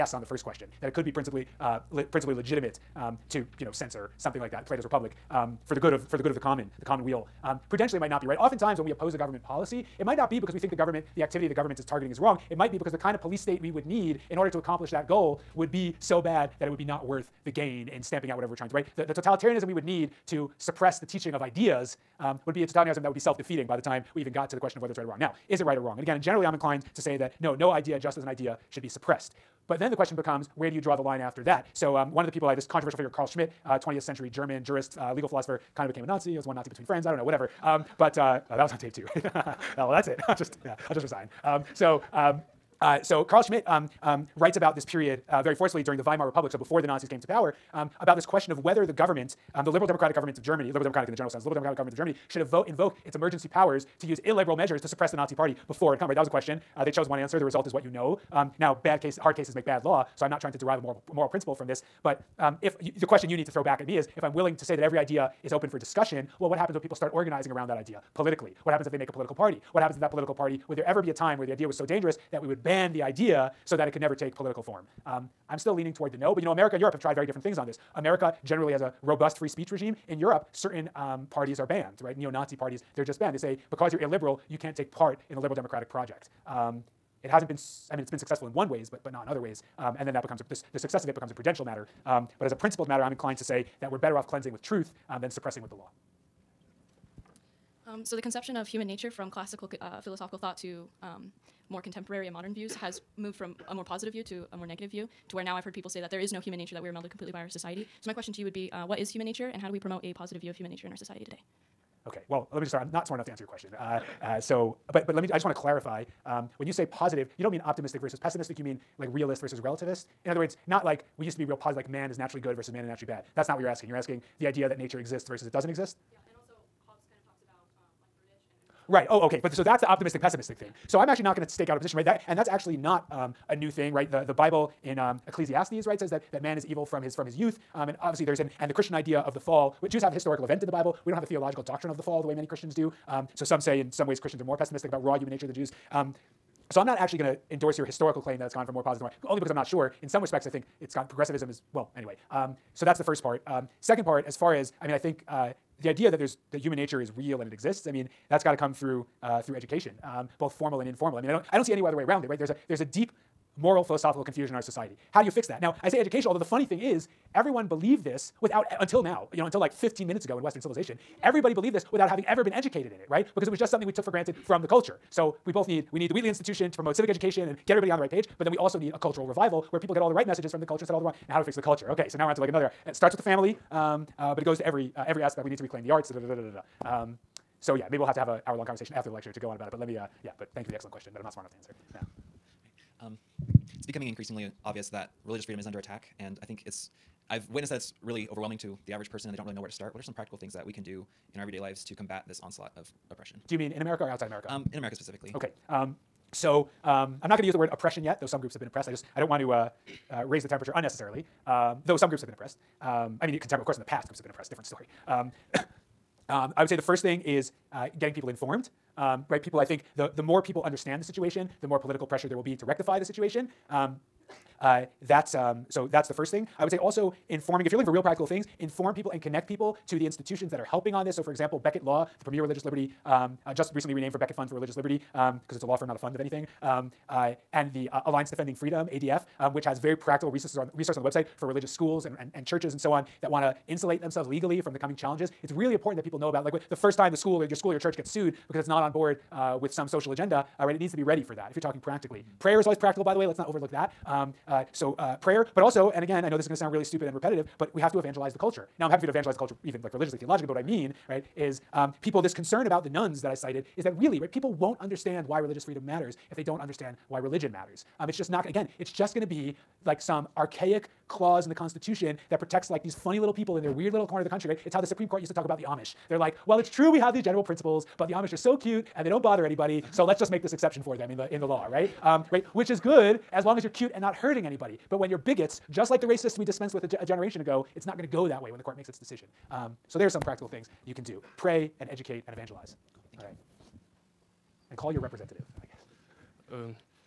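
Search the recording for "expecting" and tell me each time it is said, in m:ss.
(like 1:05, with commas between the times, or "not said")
not said.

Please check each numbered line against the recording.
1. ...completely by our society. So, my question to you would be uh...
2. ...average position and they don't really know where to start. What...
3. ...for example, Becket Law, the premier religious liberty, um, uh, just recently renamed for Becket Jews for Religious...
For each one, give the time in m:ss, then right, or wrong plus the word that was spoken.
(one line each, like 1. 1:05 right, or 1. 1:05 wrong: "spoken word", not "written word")
1. 1:47 right
2. 3:18 wrong: "person", not "position"
3. 3:51 wrong: "Fund", not "Jews".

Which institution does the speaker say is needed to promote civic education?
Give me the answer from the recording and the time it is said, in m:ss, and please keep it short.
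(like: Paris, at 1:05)
Wheatley Institution, at 2:56.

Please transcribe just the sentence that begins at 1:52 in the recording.
Okay, well, let me just start.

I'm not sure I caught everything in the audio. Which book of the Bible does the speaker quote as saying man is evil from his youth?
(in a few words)
Ecclesiastes.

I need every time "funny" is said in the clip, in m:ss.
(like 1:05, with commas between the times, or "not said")
2:46, 4:32.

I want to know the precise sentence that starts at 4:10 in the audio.
It needs to be ready for that if you're talking practically.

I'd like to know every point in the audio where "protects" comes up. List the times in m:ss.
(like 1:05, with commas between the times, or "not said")
4:32.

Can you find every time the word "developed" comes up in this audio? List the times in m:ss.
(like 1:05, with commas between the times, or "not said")
not said.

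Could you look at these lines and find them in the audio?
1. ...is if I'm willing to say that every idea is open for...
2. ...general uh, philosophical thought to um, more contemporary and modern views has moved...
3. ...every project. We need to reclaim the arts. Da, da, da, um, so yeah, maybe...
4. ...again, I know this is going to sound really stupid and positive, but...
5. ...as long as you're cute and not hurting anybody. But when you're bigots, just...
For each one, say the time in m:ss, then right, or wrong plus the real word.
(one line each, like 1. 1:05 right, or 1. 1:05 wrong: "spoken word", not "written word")
1. 1:03 right
2. 1:39 wrong: "classical", not "general"
3. 3:05 wrong: "aspect", not "project"
4. 4:16 wrong: "repetitive", not "positive"
5. 4:43 right.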